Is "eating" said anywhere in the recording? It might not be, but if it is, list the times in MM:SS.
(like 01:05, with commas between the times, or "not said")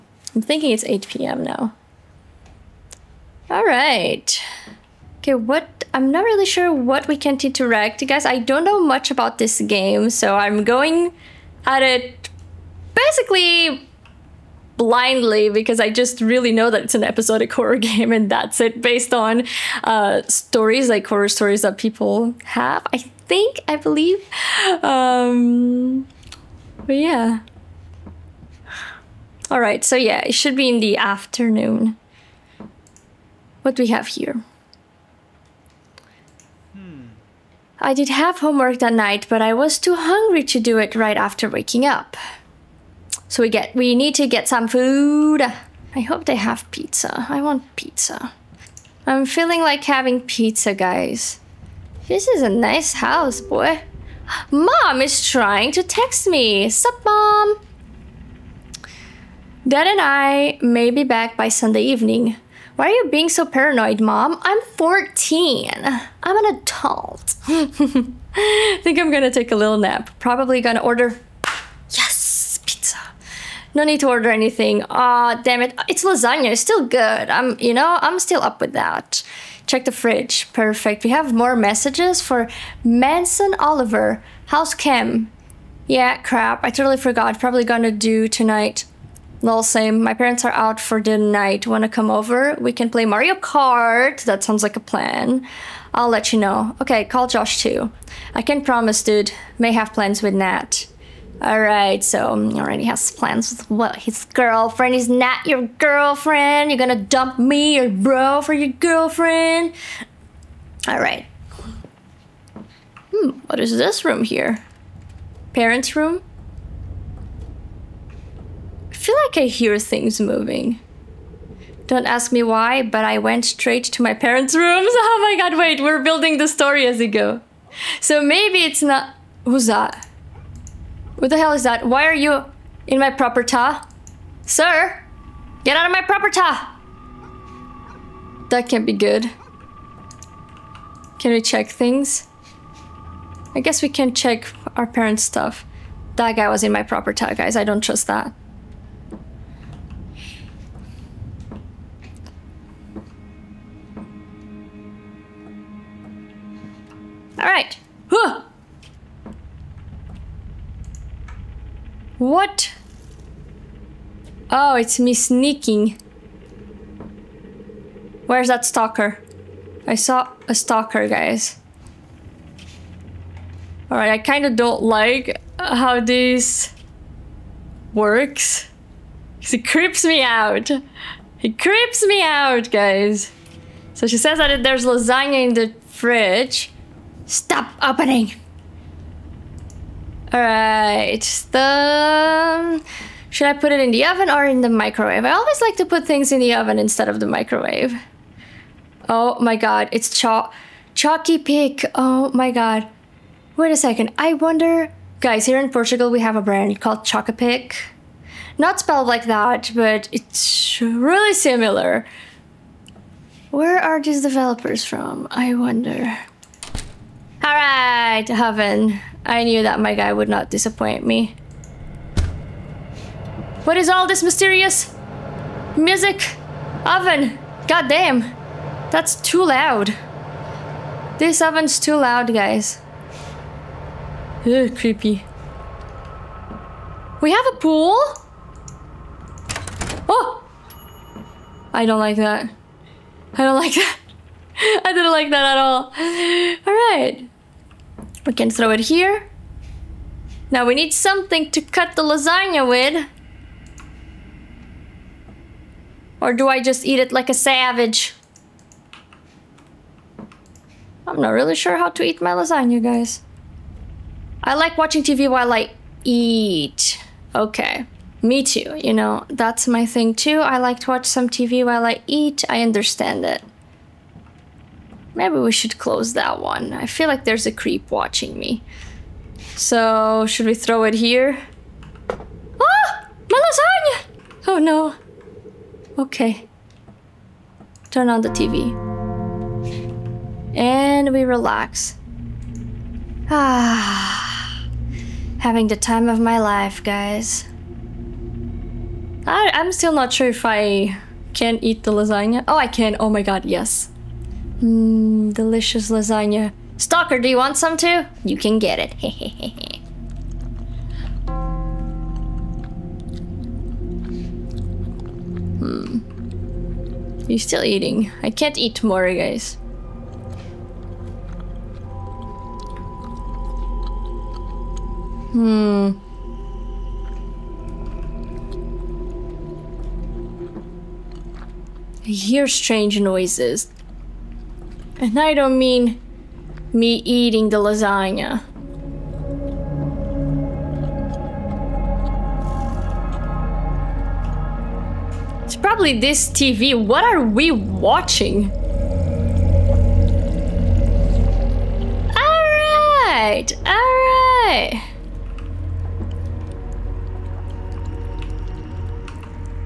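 05:17, 05:37.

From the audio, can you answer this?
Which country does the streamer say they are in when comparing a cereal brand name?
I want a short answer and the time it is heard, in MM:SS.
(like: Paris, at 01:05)
Portugal, at 03:25.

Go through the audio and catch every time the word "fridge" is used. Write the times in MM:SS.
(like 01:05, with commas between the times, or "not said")
01:19, 03:05.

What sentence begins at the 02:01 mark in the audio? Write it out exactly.
Don't ask me why, but I went straight to my parents' rooms.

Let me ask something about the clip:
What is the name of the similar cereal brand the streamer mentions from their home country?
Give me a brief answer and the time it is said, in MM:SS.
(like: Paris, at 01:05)
Chocapic, at 03:27.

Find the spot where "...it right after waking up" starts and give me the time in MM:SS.
00:40.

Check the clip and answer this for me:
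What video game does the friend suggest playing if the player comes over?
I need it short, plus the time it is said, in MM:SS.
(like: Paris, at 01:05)
Mario Kart, at 01:32.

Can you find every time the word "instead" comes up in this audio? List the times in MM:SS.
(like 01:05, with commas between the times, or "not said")
03:16.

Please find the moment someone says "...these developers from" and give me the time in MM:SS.
03:34.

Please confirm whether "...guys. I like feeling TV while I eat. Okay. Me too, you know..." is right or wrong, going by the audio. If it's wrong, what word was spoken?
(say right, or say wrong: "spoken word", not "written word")
wrong: "watching", not "feeling".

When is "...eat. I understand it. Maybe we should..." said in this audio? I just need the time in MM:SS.
04:32.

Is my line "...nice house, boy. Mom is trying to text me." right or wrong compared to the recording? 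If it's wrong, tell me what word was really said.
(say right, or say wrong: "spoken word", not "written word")
right.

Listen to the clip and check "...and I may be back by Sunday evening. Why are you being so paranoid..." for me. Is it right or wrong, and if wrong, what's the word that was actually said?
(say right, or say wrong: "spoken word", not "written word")
right.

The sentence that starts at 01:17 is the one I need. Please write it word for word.
I'm, you know, I'm still up with that.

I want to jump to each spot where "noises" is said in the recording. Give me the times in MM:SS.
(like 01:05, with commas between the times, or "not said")
05:33.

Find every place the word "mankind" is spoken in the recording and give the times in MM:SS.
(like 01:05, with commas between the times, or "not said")
not said.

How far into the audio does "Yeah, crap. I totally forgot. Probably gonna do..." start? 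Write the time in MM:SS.
01:25.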